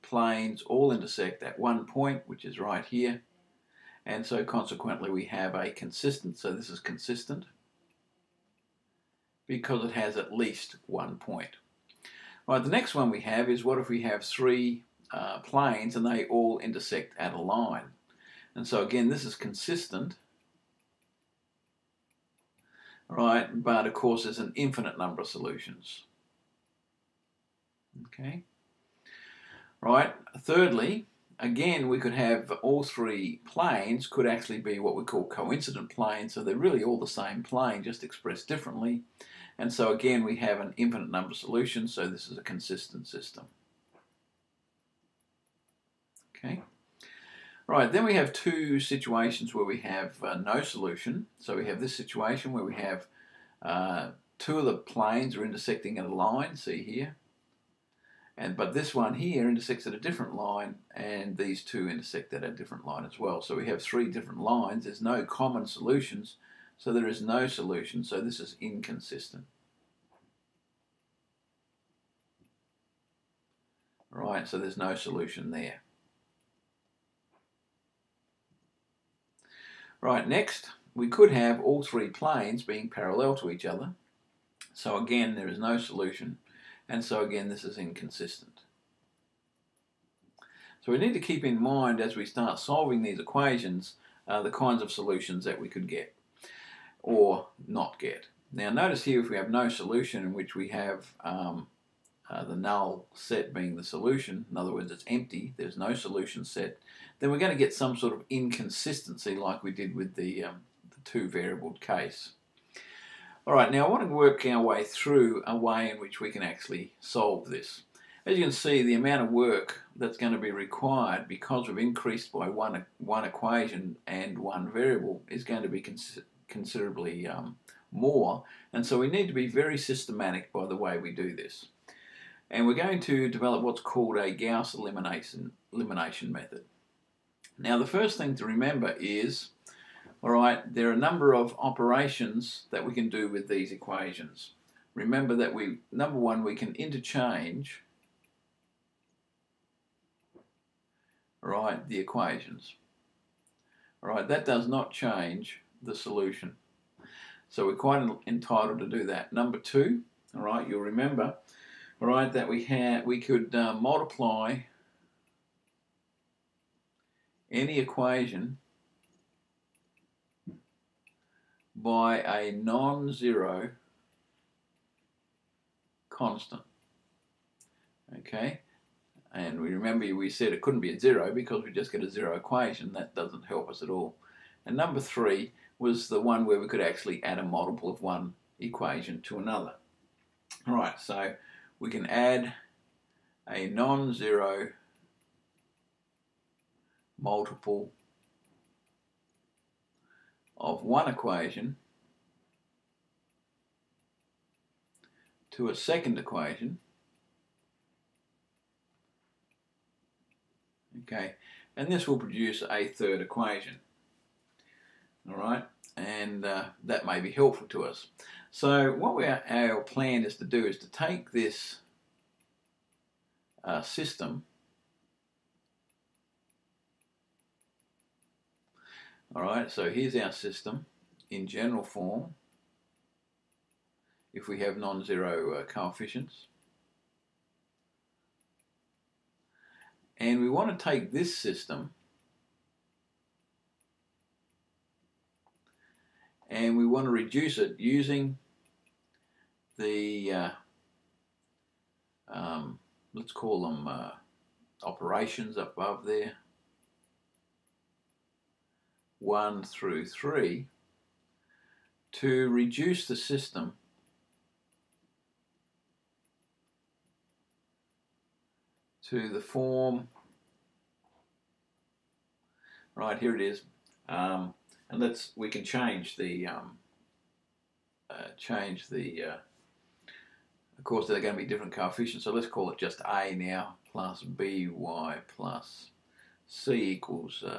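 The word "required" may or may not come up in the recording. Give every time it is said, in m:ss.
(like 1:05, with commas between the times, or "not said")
2:00.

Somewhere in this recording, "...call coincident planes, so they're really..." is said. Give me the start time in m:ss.
0:35.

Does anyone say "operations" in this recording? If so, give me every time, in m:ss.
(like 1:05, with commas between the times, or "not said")
2:21, 4:14.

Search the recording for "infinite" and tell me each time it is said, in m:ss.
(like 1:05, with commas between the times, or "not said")
0:24, 0:40.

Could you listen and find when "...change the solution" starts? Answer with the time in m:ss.
2:34.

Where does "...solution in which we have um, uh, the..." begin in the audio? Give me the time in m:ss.
1:39.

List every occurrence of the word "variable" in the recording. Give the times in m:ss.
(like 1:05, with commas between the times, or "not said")
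1:51, 2:04.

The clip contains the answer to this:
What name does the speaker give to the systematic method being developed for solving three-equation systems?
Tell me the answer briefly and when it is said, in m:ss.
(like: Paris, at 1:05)
Gauss elimination, at 2:14.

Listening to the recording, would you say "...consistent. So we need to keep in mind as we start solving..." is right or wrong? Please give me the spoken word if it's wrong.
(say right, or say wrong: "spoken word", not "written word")
wrong: "inconsistent", not "consistent".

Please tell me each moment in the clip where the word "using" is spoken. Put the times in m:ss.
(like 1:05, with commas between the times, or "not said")
4:07.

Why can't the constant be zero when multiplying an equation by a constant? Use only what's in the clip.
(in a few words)
a zero equation.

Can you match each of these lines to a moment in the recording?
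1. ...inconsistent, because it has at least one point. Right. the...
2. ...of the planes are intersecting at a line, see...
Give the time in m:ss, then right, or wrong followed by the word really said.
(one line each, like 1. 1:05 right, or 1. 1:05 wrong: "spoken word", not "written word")
1. 0:06 wrong: "consistent", not "inconsistent"
2. 0:54 right.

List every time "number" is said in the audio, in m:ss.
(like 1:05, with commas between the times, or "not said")
0:24, 0:41, 2:20, 2:25, 2:39, 3:04.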